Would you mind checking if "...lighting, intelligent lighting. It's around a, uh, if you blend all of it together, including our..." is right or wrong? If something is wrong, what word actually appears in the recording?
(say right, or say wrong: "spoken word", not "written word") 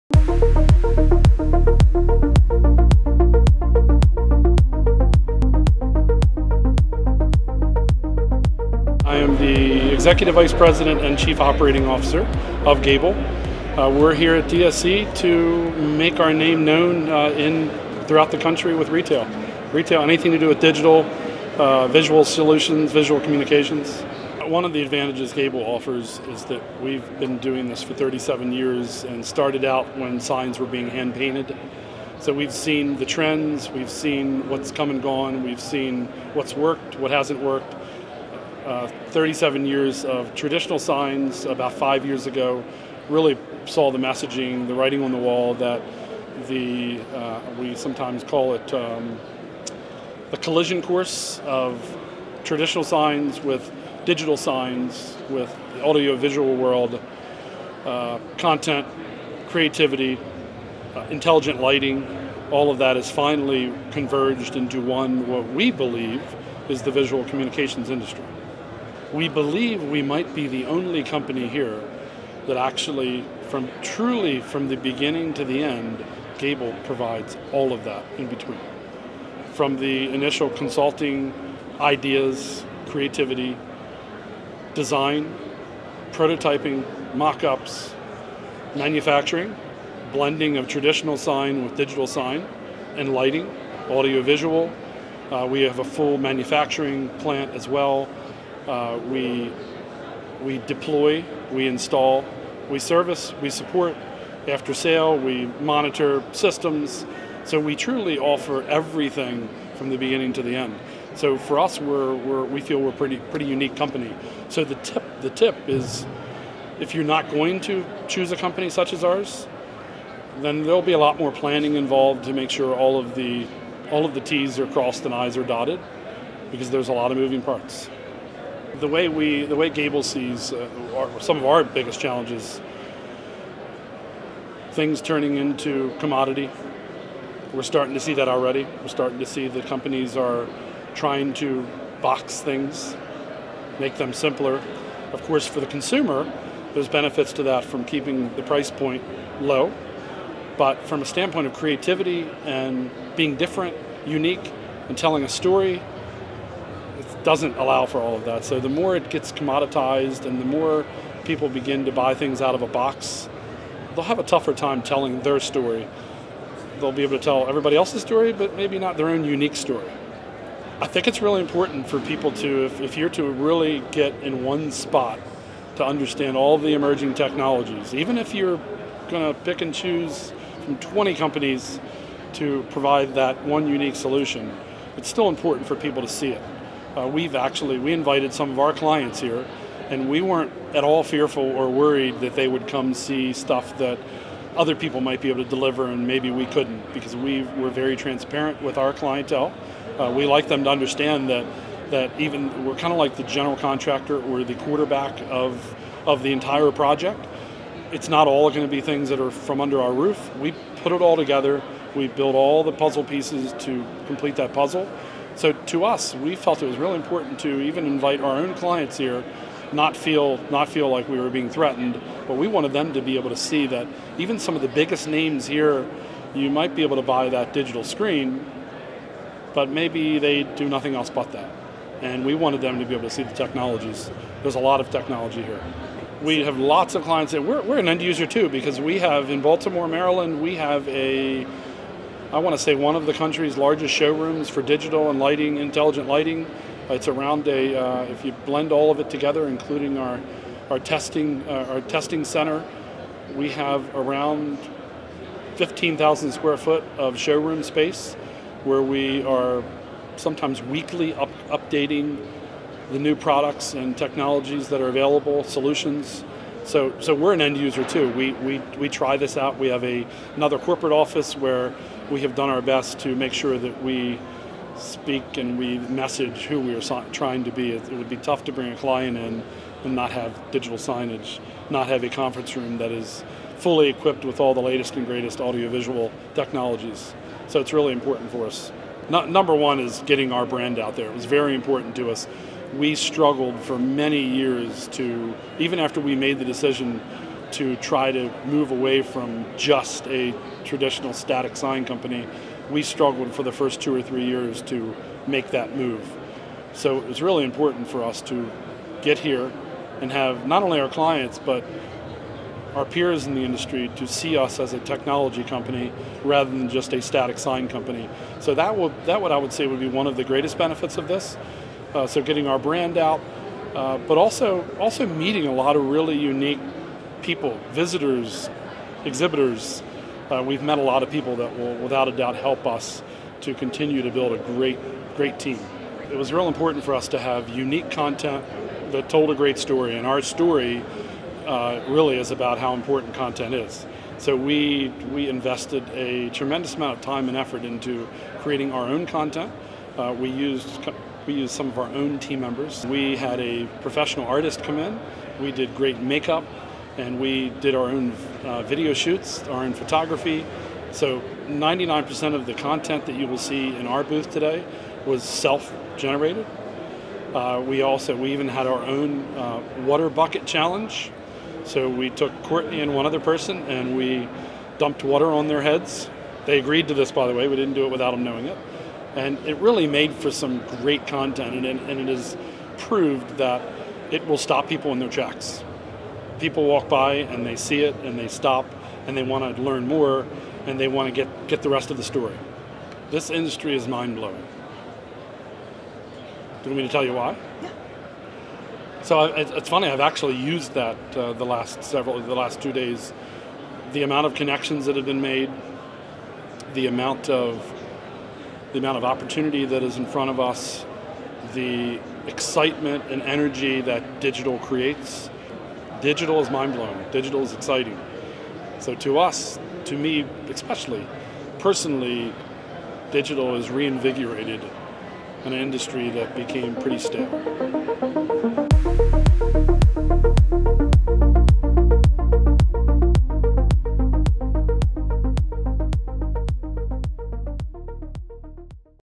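right.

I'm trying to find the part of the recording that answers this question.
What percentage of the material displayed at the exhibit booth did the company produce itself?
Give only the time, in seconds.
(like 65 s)
361 s.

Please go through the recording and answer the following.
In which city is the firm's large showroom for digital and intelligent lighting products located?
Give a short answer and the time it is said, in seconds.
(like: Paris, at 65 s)
Baltimore, Maryland, at 239 s.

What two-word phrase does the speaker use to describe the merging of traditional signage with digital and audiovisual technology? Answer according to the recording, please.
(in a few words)
Collision course.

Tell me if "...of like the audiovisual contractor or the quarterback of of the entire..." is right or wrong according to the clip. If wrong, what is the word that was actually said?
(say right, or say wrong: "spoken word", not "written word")
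wrong: "general", not "audiovisual".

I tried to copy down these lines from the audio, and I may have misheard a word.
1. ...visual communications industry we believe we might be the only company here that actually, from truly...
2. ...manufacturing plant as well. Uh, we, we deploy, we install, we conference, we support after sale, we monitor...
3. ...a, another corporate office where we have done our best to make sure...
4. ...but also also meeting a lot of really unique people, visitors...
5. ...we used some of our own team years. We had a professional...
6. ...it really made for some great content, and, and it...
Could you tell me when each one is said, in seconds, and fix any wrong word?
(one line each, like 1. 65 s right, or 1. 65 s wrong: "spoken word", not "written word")
1. 66 s right
2. 96 s wrong: "service", not "conference"
3. 269 s right
4. 323 s right
5. 351 s wrong: "members", not "years"
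6. 379 s right.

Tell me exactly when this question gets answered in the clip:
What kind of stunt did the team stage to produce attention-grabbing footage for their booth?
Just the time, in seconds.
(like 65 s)
369 s.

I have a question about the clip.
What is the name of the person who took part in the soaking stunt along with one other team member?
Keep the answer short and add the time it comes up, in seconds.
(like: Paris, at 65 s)
Courtney, at 372 s.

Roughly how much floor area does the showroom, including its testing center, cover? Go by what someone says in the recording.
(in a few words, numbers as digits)
15,000 square feet.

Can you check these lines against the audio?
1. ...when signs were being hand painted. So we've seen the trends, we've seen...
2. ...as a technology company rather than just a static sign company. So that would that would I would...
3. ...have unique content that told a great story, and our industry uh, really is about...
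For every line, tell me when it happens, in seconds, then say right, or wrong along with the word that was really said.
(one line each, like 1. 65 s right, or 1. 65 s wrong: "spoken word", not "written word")
1. 29 s right
2. 314 s right
3. 337 s wrong: "story", not "industry".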